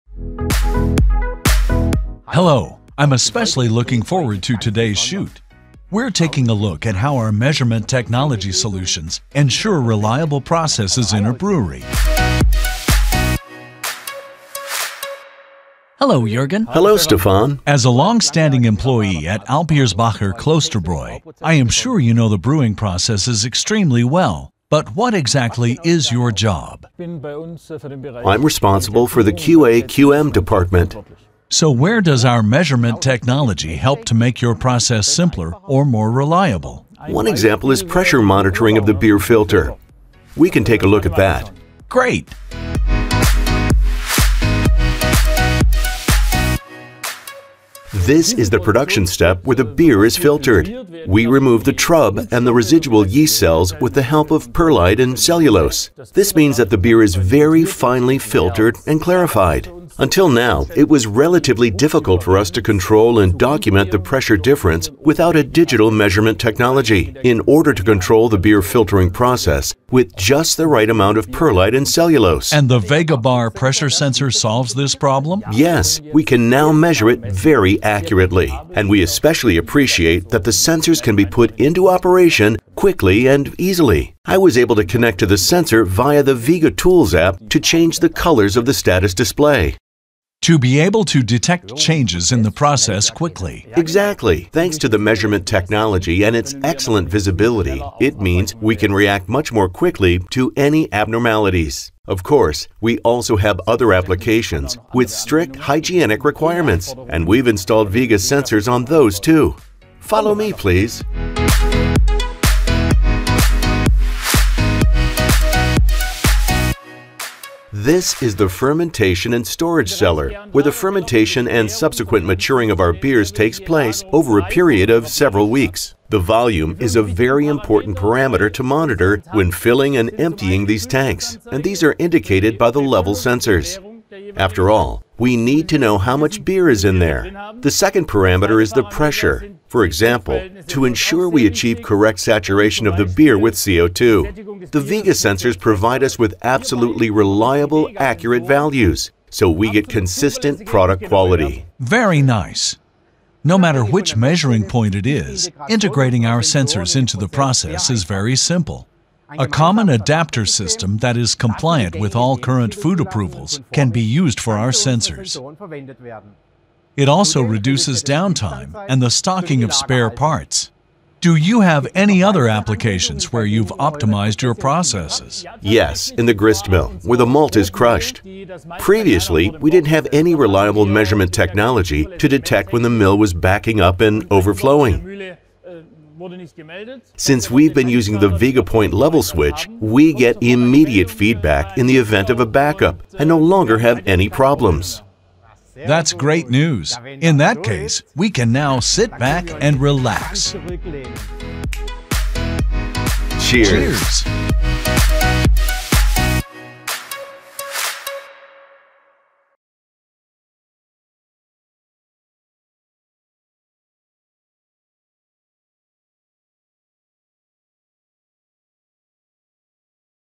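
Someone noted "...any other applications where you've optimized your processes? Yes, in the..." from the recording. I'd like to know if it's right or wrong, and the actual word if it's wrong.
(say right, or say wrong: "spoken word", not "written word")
right.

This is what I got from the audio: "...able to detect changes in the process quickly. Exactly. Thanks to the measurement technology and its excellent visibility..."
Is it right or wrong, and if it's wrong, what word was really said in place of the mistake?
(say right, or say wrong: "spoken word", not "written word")
right.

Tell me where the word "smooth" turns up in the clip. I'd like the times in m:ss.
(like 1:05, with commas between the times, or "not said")
not said.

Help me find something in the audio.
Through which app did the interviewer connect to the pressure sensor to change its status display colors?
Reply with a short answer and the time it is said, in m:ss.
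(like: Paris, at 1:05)
Vega Tools app, at 1:26.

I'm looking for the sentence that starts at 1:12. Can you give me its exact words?
And the Vega Bar pressure sensor solves this problem?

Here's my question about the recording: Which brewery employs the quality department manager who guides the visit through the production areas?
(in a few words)
Alpirsbacher Klosterbräu.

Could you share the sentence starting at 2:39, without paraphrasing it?
A common adapter system that is compliant with all current food approvals can be used for our sensors.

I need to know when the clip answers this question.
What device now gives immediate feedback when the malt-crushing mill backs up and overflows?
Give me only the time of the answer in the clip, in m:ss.
3:08.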